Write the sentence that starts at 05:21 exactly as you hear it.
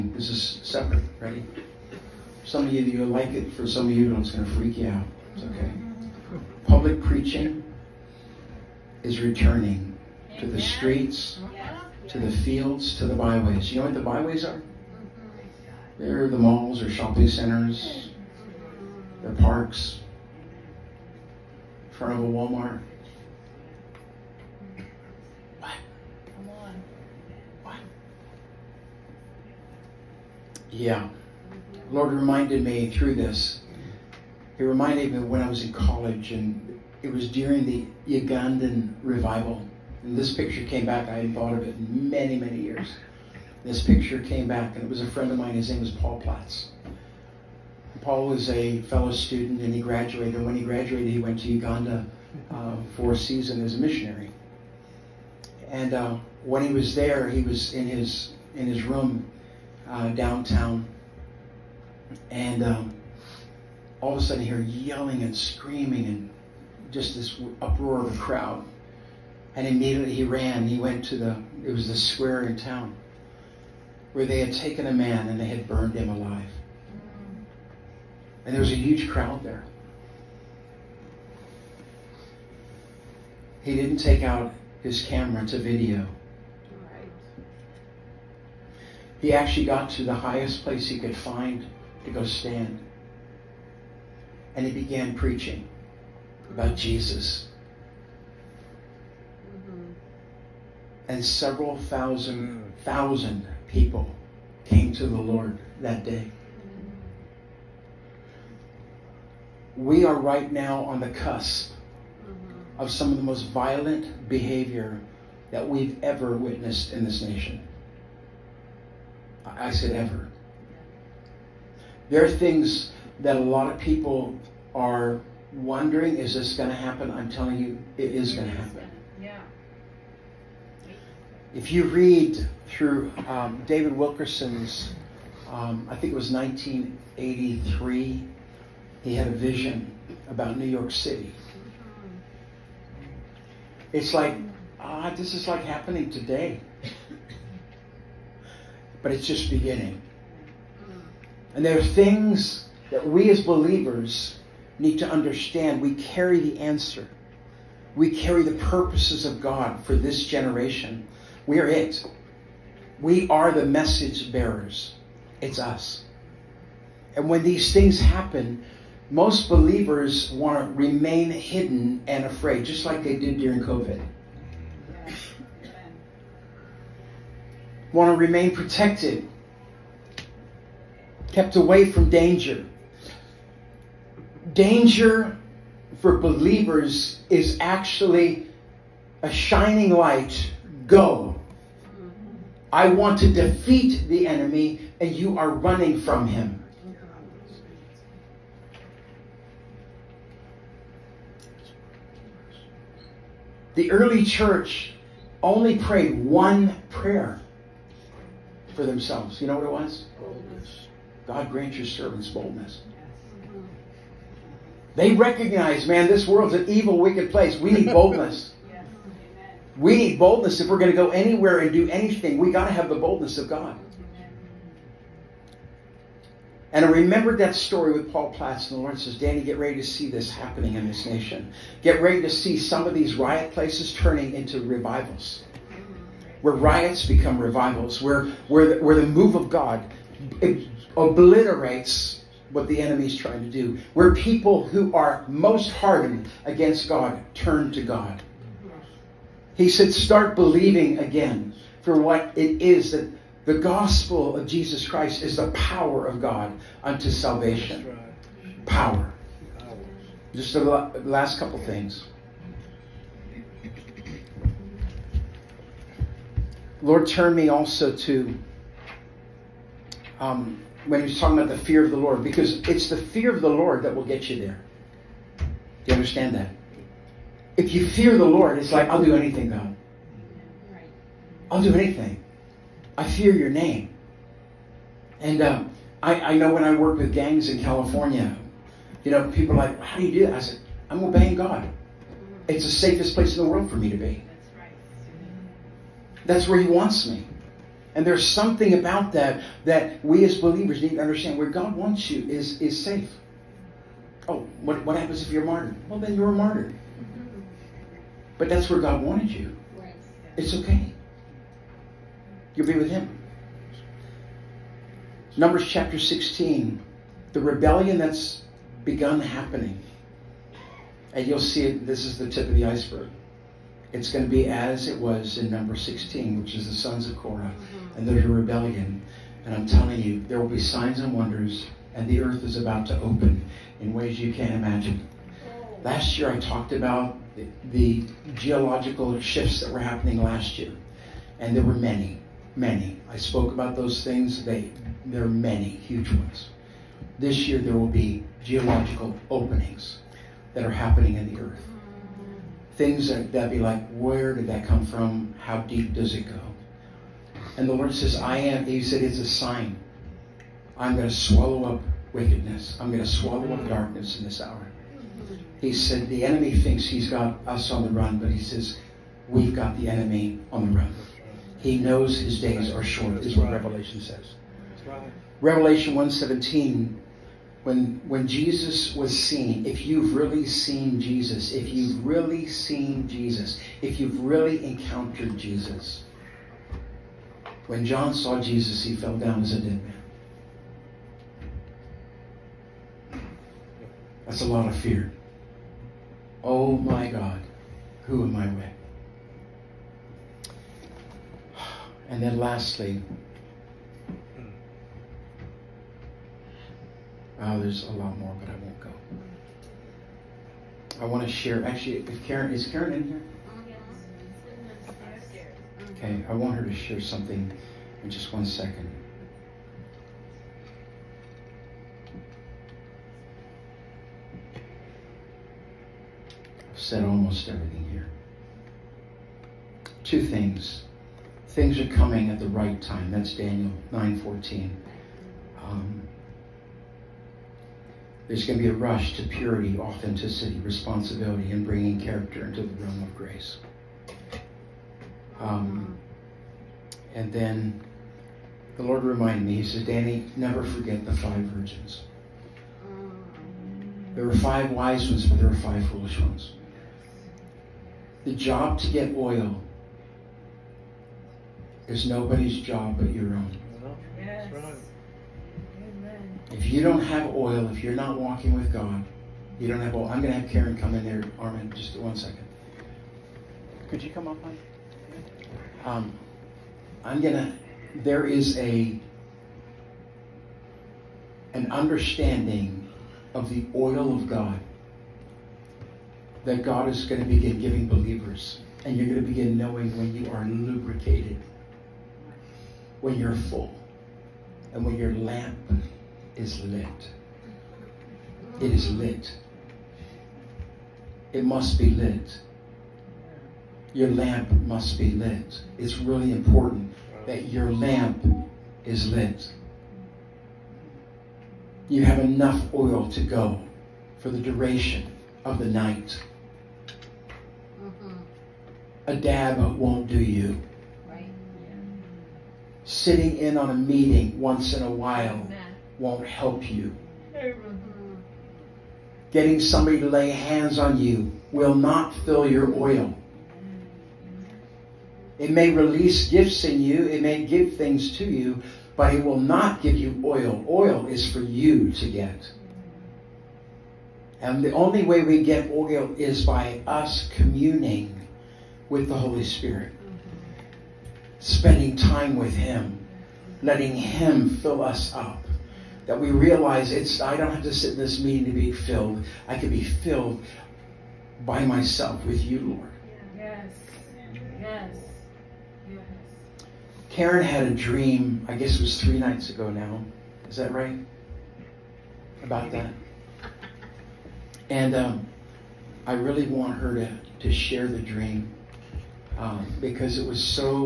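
And you'll see it, this is the tip of the iceberg.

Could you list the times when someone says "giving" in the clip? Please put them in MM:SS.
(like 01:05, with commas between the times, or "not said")
08:07.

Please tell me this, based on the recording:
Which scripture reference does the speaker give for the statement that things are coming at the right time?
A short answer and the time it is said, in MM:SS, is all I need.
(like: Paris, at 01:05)
Daniel 9:14, at 07:13.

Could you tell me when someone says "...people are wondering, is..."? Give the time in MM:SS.
02:03.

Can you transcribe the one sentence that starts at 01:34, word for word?
And he began preaching about Jesus.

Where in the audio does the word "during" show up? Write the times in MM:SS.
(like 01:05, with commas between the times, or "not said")
00:37, 02:53.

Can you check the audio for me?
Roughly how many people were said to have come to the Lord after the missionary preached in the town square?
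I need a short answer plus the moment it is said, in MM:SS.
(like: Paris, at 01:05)
several thousand, at 01:41.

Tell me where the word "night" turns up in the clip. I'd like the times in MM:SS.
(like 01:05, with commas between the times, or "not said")
08:35, 09:29.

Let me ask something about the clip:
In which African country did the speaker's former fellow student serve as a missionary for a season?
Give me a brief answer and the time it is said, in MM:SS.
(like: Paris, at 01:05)
Uganda, at 00:51.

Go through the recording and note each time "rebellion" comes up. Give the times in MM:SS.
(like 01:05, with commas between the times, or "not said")
05:17, 05:28.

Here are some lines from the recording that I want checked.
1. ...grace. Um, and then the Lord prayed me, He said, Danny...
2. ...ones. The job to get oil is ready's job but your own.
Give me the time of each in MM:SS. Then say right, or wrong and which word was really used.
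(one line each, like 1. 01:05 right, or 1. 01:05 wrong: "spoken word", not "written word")
1. 07:23 wrong: "reminded", not "prayed"
2. 07:36 wrong: "nobody", not "ready".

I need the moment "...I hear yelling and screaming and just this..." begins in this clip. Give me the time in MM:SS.
01:04.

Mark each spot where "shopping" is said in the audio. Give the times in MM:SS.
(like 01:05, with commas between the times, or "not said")
00:16.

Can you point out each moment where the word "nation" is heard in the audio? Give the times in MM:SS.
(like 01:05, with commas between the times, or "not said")
01:57, 03:51.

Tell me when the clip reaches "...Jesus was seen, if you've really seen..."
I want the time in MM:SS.
06:18.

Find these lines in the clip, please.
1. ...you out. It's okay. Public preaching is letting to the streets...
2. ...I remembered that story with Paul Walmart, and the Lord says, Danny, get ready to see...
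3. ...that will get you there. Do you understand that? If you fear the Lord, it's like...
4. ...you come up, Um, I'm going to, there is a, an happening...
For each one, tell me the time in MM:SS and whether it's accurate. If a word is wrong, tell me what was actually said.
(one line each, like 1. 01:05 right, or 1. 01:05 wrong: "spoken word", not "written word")
1. 00:04 wrong: "returning", not "letting"
2. 03:46 wrong: "Platts", not "Walmart"
3. 04:33 right
4. 07:54 wrong: "understanding", not "happening".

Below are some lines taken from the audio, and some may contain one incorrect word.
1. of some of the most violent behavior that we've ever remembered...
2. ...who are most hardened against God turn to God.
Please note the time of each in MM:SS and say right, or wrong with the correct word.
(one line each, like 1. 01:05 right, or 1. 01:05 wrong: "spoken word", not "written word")
1. 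01:52 wrong: "witnessed", not "remembered"
2. 04:04 right.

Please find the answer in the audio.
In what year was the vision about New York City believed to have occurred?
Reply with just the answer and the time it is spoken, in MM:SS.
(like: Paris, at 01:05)
1983, at 02:16.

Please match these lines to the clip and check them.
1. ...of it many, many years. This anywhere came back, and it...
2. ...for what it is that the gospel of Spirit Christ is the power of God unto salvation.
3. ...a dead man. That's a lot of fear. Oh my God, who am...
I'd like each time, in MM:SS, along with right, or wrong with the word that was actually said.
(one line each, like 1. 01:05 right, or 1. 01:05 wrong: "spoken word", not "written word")
1. 00:41 wrong: "picture", not "anywhere"
2. 04:11 wrong: "Jesus", not "Spirit"
3. 06:29 right.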